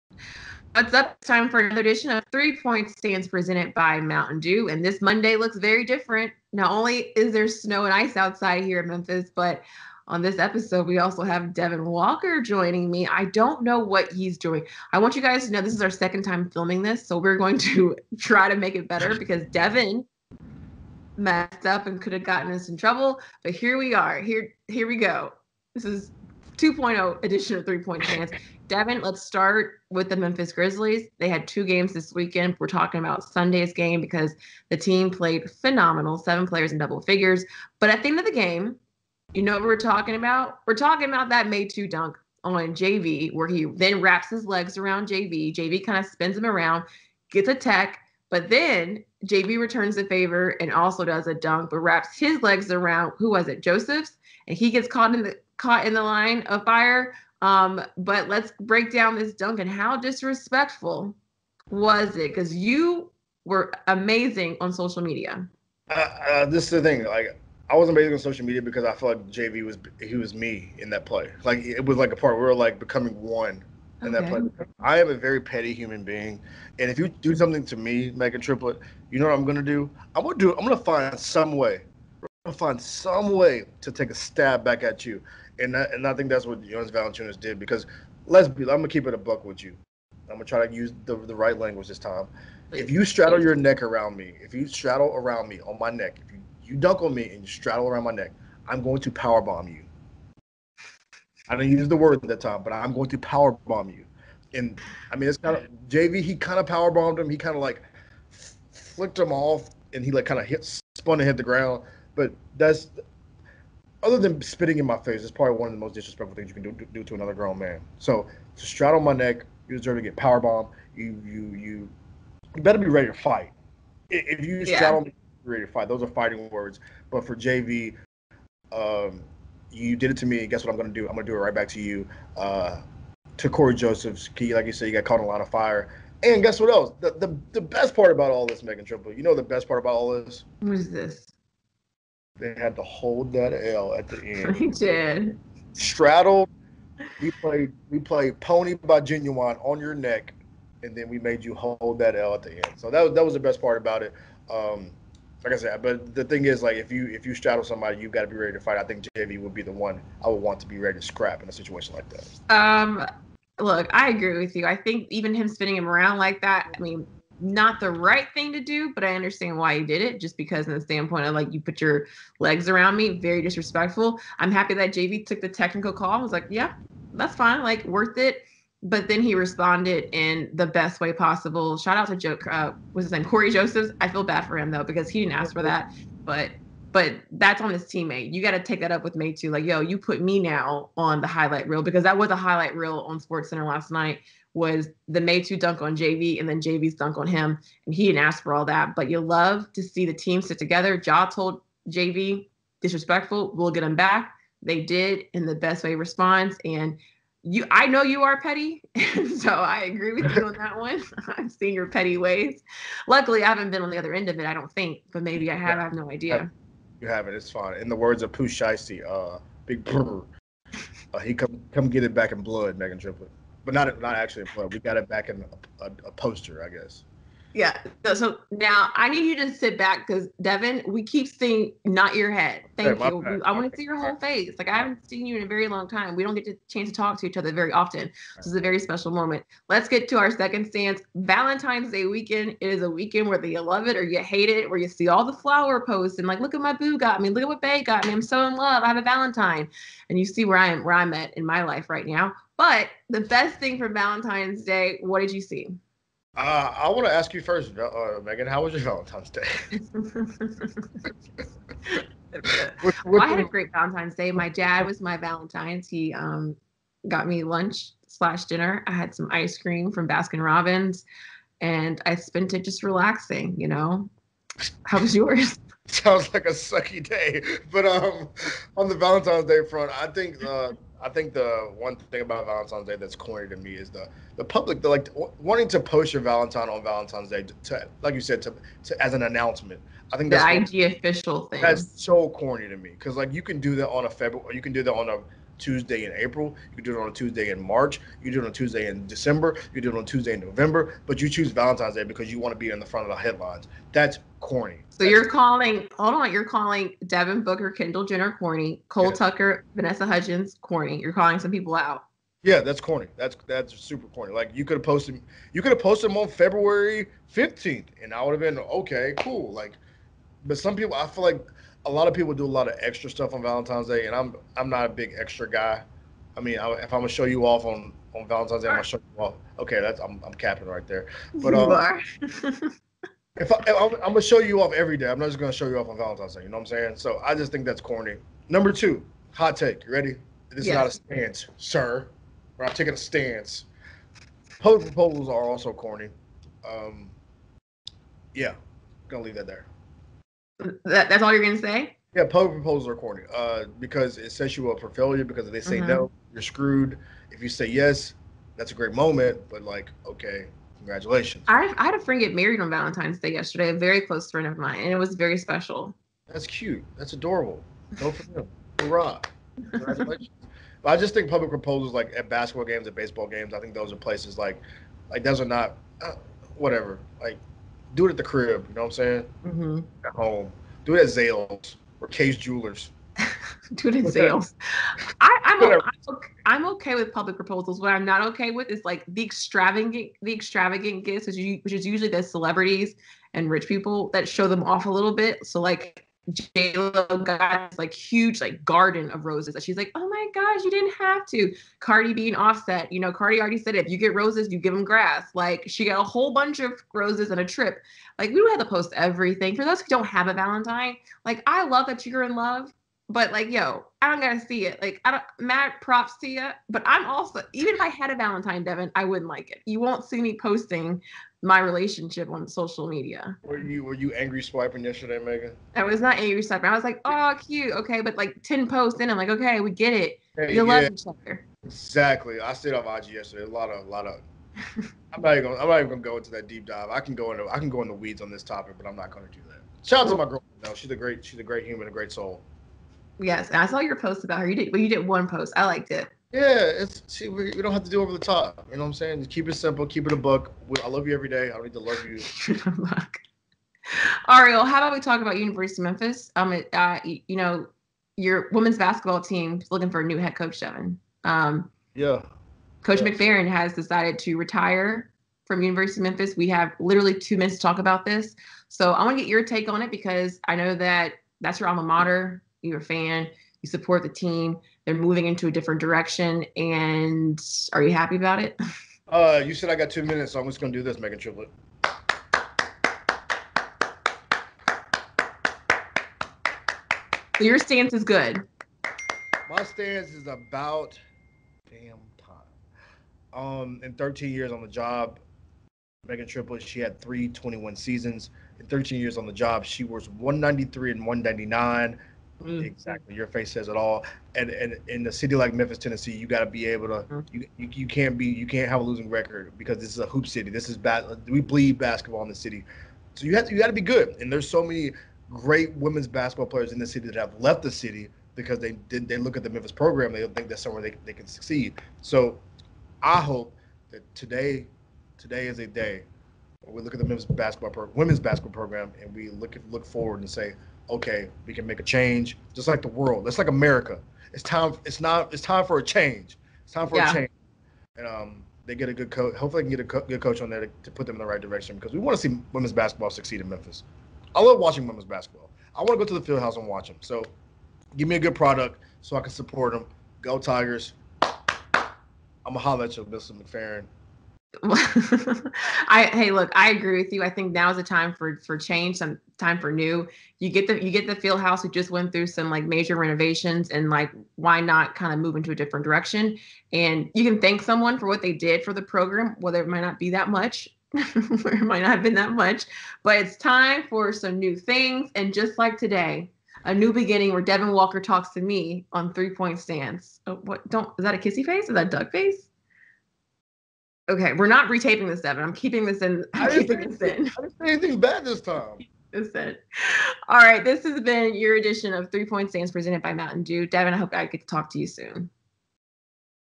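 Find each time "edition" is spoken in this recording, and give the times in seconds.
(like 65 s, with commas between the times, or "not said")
1 s, 27 s, 591 s.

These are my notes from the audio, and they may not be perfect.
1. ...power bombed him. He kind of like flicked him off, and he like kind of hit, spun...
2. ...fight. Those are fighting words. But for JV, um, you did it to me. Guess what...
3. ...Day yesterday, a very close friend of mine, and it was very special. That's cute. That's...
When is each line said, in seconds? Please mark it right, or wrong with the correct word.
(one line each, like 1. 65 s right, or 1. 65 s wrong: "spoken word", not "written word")
1. 106 s right
2. 125 s right
3. 363 s right.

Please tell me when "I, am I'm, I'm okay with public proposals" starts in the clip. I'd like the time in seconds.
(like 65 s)
385 s.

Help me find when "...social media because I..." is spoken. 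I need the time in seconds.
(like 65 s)
68 s.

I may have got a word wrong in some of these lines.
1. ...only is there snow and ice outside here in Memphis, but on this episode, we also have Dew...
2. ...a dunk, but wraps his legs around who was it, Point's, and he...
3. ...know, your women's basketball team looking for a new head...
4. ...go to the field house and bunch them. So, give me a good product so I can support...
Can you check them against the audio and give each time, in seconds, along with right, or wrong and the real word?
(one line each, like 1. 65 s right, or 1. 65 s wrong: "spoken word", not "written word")
1. 6 s wrong: "Devin", not "Dew"
2. 51 s wrong: "Joseph", not "Point"
3. 457 s right
4. 545 s wrong: "watch", not "bunch".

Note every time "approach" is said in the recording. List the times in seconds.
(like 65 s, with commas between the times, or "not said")
not said.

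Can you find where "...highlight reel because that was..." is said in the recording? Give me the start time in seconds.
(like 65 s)
191 s.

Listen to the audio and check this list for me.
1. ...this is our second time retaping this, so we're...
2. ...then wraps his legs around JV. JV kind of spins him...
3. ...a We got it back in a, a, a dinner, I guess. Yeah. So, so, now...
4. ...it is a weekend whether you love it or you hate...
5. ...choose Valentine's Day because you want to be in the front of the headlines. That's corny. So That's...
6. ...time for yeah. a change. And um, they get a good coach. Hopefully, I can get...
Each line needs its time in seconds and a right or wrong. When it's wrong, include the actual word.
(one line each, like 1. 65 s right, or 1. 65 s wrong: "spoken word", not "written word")
1. 15 s wrong: "filming", not "retaping"
2. 43 s right
3. 224 s wrong: "poster", not "dinner"
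4. 242 s right
5. 301 s right
6. 536 s right.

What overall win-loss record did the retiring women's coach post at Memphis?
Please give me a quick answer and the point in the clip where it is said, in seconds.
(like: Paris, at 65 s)
193-199, at 500 s.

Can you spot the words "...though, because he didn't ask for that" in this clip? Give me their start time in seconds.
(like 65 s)
184 s.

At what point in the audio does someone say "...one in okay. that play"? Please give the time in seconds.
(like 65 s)
73 s.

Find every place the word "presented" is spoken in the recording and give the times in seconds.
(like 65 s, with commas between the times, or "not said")
3 s, 592 s.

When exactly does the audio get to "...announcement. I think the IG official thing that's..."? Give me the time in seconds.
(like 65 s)
289 s.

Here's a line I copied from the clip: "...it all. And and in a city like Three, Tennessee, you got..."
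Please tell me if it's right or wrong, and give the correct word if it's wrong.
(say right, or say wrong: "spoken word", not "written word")
wrong: "Memphis", not "Three".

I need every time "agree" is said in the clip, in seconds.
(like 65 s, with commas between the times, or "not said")
164 s, 209 s, 556 s.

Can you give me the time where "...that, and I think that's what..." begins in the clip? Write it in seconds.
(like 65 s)
85 s.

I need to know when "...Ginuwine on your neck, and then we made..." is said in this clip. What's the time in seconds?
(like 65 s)
149 s.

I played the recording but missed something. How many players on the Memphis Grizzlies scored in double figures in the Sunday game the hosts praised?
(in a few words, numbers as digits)
7.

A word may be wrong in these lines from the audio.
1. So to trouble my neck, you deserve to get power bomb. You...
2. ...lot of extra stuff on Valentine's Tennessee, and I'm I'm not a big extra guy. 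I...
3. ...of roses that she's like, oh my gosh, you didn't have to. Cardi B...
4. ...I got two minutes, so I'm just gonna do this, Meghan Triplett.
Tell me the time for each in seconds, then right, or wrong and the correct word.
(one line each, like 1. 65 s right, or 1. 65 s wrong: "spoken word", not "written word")
1. 117 s wrong: "straddle", not "trouble"
2. 322 s wrong: "Day", not "Tennessee"
3. 399 s right
4. 479 s right.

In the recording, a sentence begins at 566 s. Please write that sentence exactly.
And you can thank someone for what they did for the program, whether it might not be that much.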